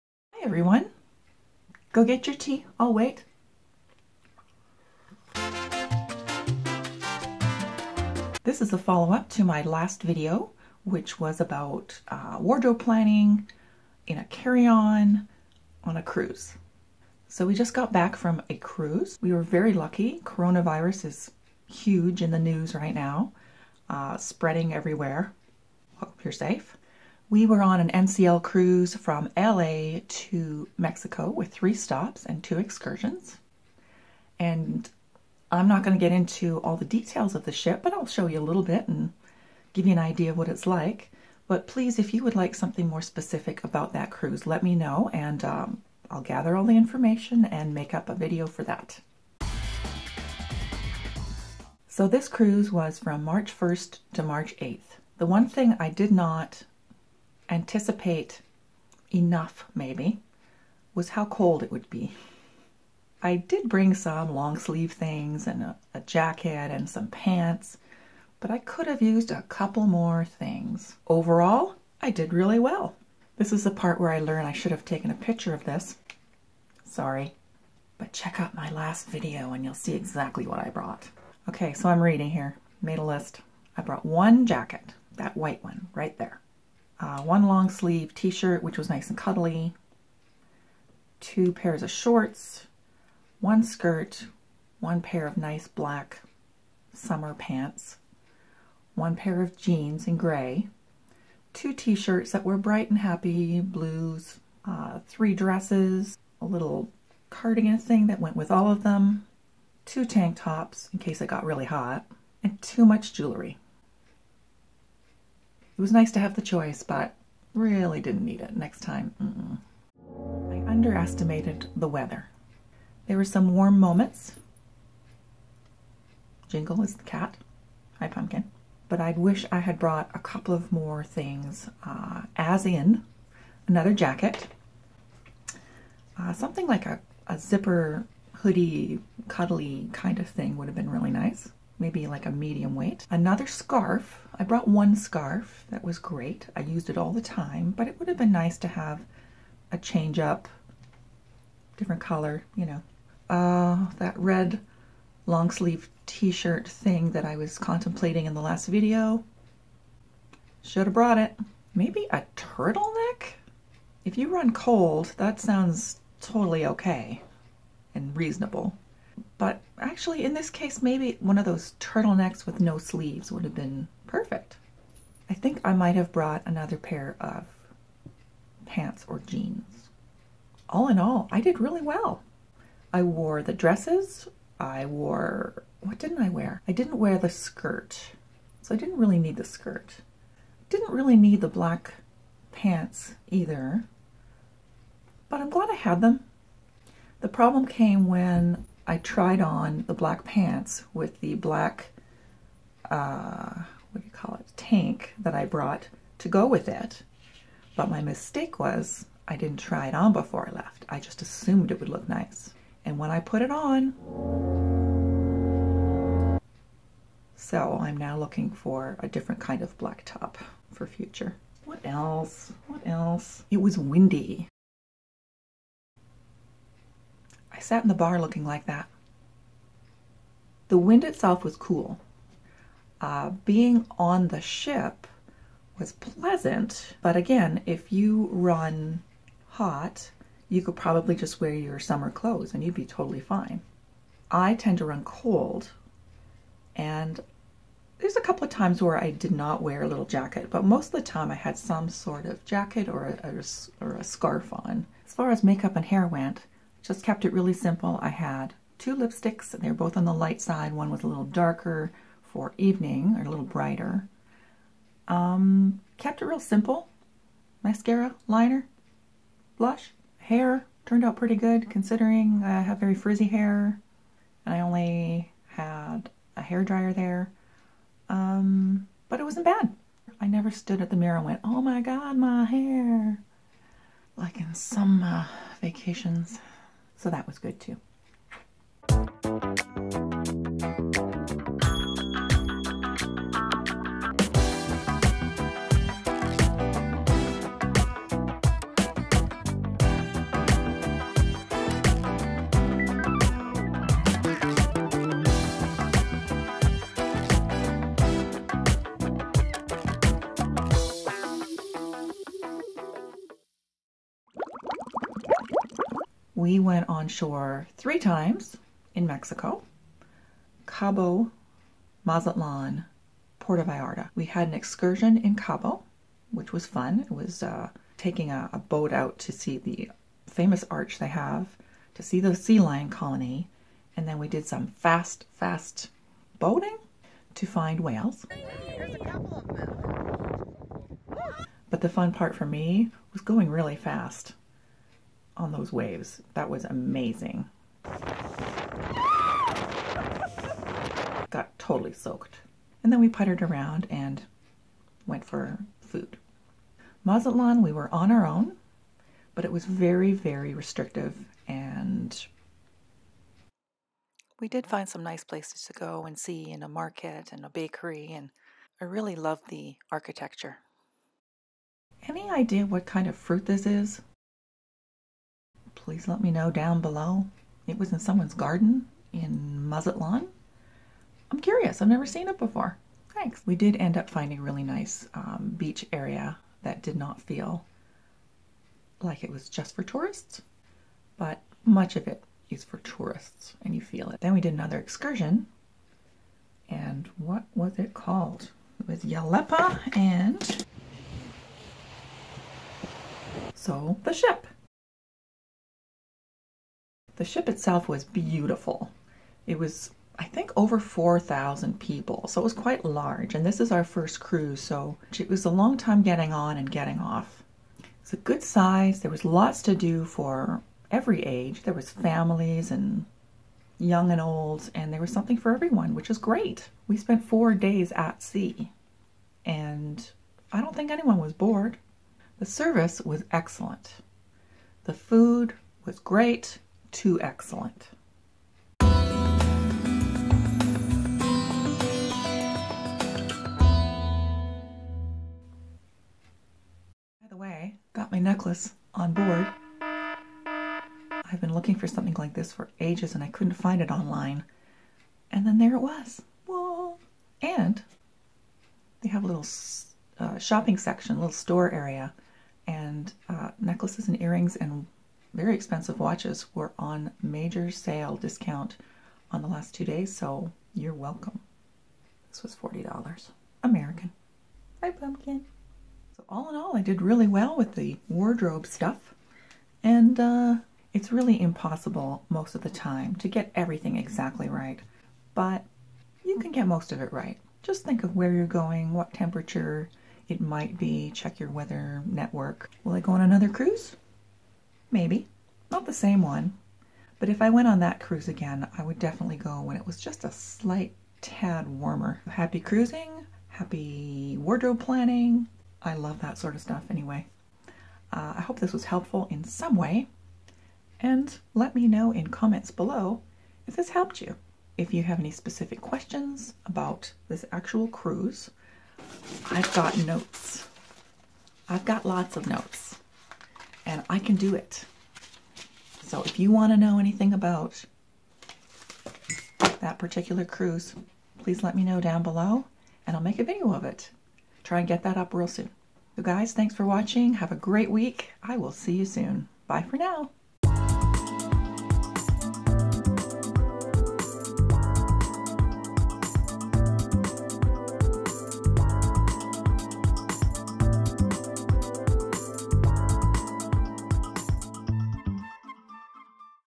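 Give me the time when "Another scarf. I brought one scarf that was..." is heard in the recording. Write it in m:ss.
2:23.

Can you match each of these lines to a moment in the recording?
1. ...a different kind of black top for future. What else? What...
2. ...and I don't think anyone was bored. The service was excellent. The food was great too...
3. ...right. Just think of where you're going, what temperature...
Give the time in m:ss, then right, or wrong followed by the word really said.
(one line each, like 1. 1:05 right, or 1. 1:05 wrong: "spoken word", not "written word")
1. 3:38 right
2. 7:09 right
3. 8:07 right.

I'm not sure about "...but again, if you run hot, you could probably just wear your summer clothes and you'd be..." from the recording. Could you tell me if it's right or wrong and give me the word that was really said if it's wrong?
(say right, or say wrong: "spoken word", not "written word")
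right.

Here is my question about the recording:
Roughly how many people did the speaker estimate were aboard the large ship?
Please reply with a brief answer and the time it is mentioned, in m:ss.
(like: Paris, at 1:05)
Over 4,000, at 6:50.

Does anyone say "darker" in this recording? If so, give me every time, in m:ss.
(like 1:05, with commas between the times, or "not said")
4:21.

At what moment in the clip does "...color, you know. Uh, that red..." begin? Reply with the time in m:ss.
2:32.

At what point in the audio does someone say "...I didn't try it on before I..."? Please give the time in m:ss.
3:29.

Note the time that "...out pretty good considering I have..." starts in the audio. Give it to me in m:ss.
4:31.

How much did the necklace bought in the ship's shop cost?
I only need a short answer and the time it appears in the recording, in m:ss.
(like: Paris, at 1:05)
$40, at 7:52.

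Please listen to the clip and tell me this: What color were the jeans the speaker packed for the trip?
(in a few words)
Gray.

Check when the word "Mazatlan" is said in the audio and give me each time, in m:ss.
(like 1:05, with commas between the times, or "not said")
5:22, 5:57, 6:19.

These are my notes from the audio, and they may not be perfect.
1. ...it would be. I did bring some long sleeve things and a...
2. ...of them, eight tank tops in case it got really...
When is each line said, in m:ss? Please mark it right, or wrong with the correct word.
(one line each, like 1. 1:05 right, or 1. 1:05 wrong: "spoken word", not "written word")
1. 1:01 right
2. 1:48 wrong: "two", not "eight".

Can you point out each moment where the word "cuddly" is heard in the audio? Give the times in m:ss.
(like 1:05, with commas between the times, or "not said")
1:29, 2:19.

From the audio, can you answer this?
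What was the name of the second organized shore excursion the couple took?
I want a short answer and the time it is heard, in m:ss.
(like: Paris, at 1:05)
Yelapa, at 6:39.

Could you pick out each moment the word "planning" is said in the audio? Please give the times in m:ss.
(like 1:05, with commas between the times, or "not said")
0:12, 8:24.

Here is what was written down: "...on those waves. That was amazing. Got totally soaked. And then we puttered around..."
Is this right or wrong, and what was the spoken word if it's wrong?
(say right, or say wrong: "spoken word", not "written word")
right.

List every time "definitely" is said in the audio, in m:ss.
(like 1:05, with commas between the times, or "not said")
8:18.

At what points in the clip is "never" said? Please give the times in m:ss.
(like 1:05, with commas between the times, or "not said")
4:40, 6:21.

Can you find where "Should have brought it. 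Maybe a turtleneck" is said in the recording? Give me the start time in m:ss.
2:40.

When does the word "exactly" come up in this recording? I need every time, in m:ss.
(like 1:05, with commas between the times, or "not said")
1:19, 8:03.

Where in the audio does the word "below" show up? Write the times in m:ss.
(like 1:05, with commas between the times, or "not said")
6:16, 8:32, 8:52.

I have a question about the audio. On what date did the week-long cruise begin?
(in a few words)
March 1st.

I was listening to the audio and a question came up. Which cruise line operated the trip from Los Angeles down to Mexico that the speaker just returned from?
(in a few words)
NCL.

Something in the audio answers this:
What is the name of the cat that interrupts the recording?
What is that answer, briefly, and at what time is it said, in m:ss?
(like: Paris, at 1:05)
Jingle, at 2:06.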